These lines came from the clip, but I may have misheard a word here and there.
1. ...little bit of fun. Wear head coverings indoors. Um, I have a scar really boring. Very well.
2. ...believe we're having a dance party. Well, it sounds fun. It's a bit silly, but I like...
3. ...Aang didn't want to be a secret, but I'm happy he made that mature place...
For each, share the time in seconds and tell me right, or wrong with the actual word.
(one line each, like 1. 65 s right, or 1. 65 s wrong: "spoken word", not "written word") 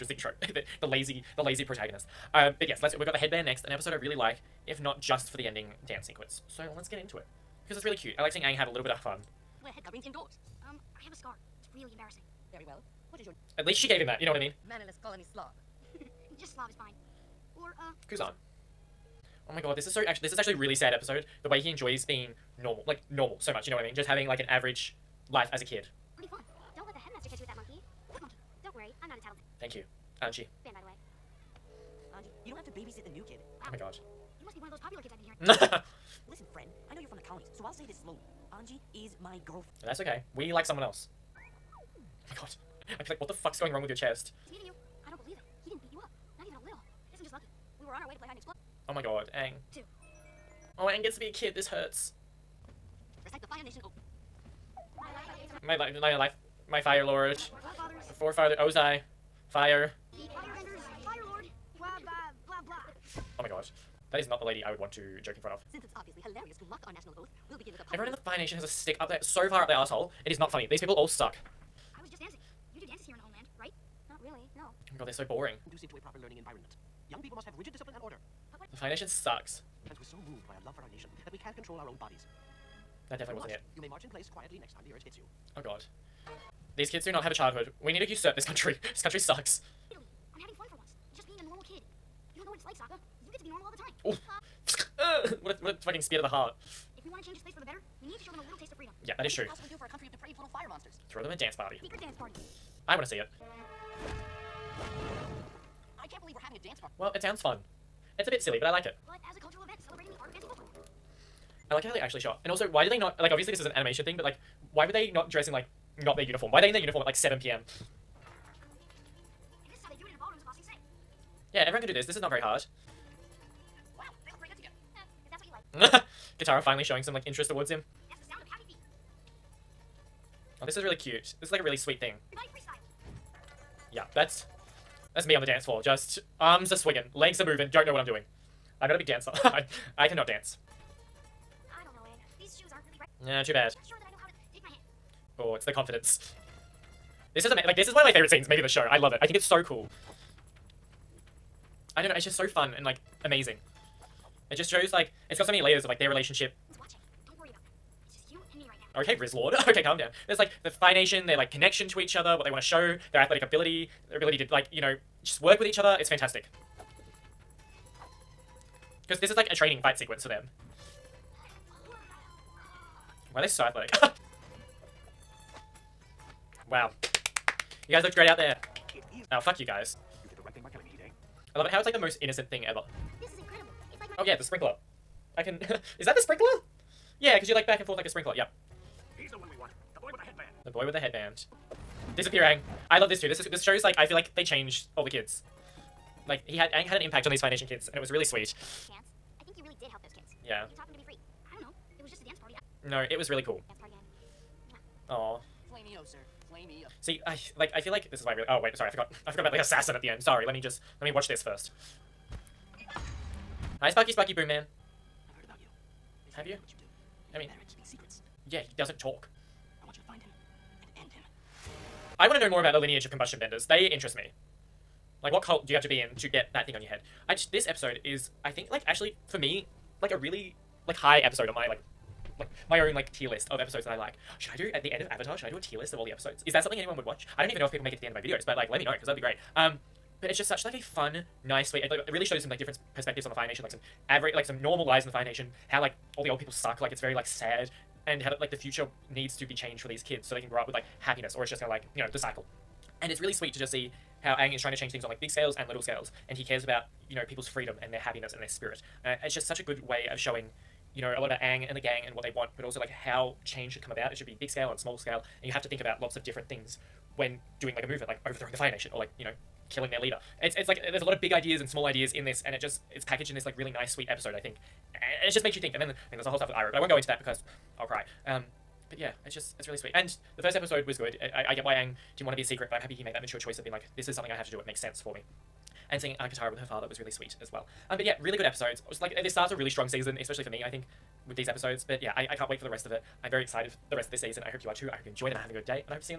1. 8 s wrong: "embarrassing", not "boring"
2. 106 s right
3. 281 s wrong: "choice", not "place".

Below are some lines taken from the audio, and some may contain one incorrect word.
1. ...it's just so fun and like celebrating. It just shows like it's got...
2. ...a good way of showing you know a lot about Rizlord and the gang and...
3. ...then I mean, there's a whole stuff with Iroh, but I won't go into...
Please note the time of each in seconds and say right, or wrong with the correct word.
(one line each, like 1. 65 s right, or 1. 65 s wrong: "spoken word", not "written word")
1. 152 s wrong: "amazing", not "celebrating"
2. 259 s wrong: "Aang", not "Rizlord"
3. 275 s right.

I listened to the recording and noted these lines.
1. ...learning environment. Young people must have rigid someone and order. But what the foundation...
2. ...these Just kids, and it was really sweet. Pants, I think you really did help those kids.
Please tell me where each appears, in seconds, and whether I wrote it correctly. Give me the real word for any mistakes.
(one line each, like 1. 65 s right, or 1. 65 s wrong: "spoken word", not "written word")
1. 76 s wrong: "discipline", not "someone"
2. 197 s wrong: "Foundation", not "Just".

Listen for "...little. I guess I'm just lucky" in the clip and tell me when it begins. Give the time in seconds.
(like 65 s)
46 s.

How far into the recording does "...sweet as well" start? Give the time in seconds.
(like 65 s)
287 s.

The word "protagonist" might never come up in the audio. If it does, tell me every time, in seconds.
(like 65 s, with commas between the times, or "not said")
1 s.